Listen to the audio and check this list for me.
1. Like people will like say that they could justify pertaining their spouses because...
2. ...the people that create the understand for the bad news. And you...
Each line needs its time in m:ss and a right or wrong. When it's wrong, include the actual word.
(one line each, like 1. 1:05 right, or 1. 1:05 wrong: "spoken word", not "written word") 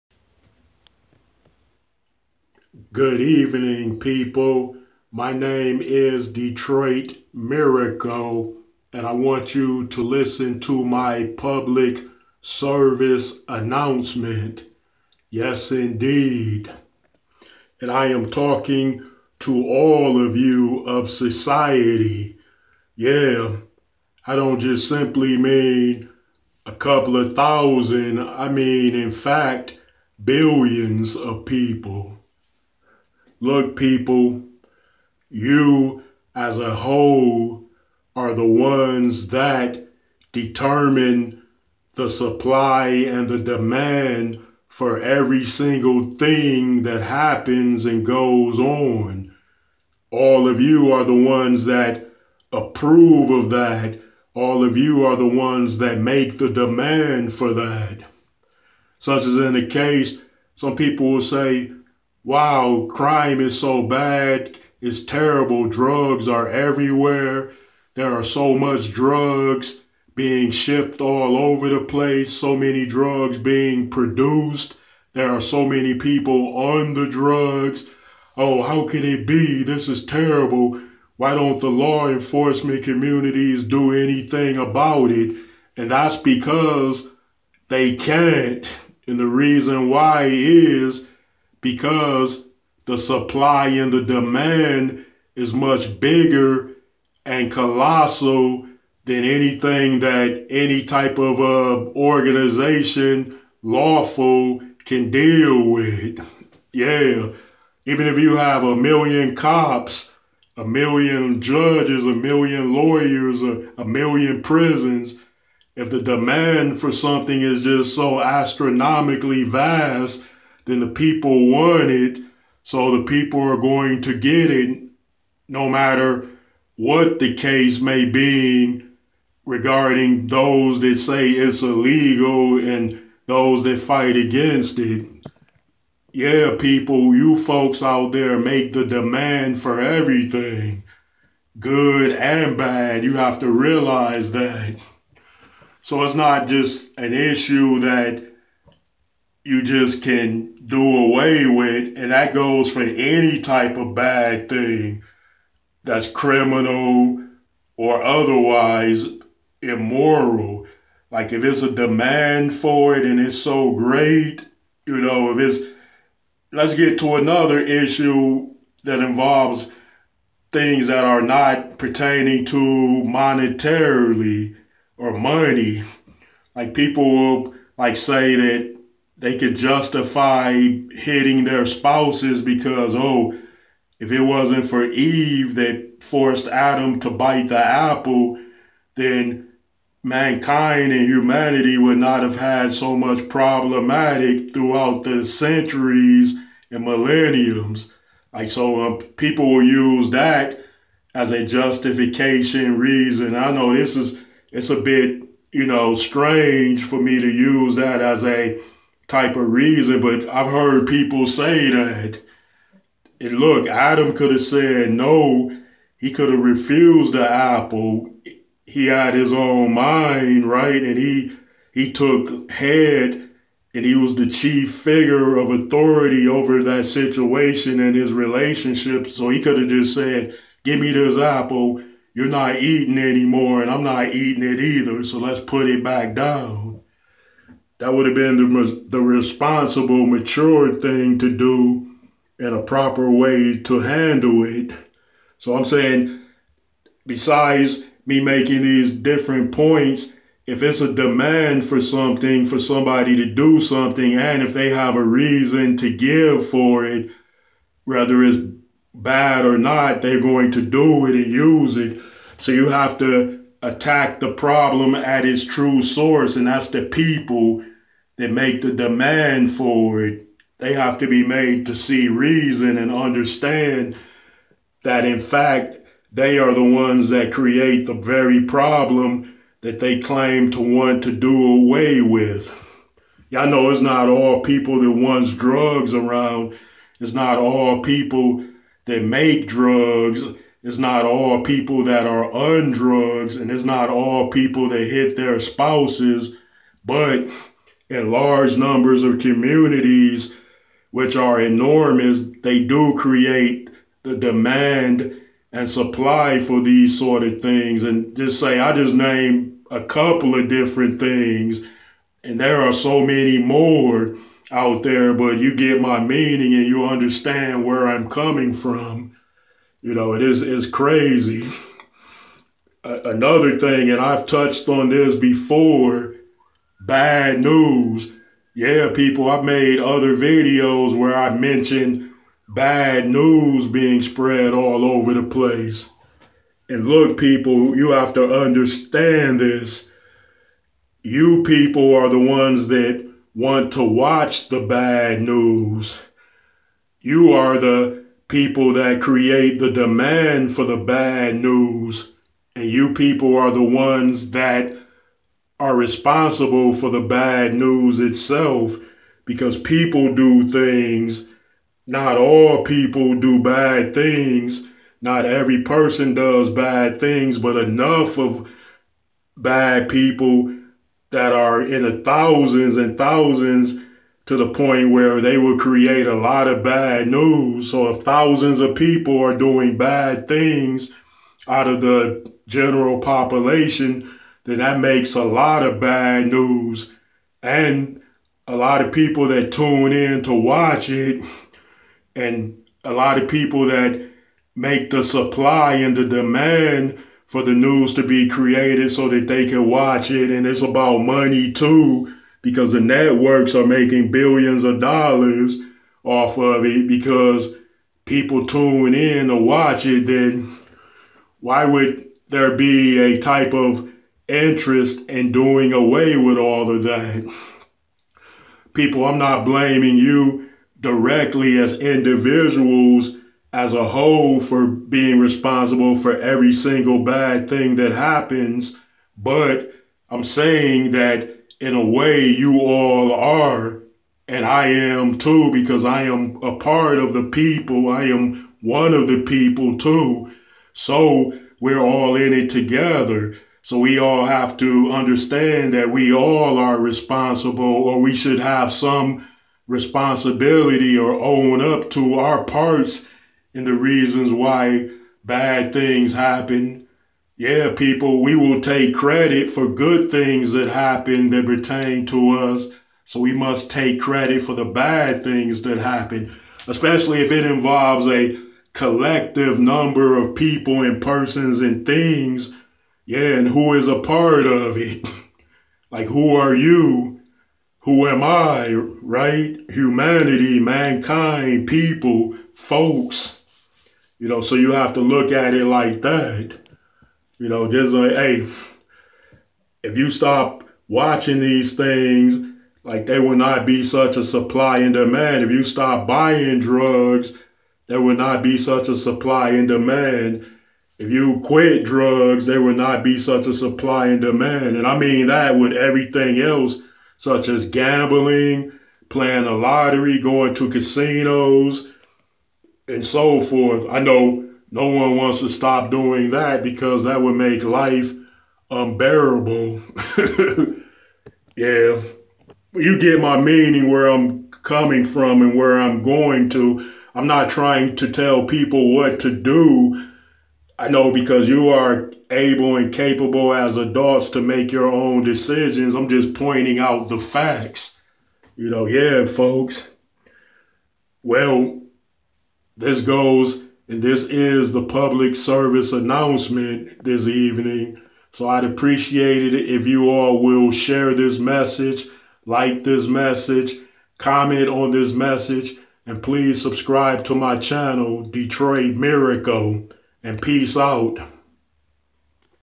1. 2:56 wrong: "hitting", not "pertaining"
2. 5:47 wrong: "demand", not "understand".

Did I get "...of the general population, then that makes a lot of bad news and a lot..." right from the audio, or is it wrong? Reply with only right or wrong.
right.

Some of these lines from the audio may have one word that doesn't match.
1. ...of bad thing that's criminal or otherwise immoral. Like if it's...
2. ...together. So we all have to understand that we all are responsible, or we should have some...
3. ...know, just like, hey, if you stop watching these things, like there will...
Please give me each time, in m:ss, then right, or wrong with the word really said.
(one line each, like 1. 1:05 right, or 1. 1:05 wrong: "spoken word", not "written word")
1. 2:33 right
2. 7:22 right
3. 8:07 right.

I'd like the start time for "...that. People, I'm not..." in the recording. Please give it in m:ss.
6:56.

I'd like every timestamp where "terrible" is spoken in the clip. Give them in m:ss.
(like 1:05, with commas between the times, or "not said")
1:05, 1:20.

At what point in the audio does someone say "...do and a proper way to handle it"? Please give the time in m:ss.
4:01.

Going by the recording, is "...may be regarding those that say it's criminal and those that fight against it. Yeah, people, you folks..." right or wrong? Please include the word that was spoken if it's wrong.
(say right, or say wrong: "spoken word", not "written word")
wrong: "illegal", not "criminal".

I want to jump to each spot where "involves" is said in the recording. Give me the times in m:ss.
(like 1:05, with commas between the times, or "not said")
2:48, 7:47.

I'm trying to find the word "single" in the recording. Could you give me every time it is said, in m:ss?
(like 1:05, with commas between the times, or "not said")
0:45, 7:06.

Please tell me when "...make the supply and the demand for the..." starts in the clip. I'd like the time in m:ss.
6:34.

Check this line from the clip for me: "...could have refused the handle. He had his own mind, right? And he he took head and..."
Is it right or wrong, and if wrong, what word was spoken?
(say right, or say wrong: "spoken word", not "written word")
wrong: "apple", not "handle".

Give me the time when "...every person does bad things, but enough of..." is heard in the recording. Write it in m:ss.
6:05.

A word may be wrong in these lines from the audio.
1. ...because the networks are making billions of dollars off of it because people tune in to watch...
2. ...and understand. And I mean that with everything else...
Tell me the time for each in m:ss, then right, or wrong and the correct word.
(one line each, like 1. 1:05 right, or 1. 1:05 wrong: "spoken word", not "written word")
1. 6:42 right
2. 8:24 wrong: "demand", not "understand".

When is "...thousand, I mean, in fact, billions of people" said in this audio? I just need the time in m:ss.
0:27.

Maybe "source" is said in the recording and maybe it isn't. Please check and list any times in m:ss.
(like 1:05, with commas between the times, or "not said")
4:25.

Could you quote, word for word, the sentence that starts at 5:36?
And look, people, you have to understand this.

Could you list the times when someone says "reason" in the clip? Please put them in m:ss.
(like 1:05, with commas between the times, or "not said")
1:29, 3:22, 3:29, 4:15, 4:32, 7:33.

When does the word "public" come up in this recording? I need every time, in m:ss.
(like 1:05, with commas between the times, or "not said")
0:11, 9:04.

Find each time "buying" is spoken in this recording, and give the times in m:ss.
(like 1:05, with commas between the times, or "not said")
8:16.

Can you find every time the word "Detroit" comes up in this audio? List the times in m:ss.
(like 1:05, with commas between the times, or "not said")
0:06, 9:18.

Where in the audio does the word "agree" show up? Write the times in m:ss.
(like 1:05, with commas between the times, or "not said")
not said.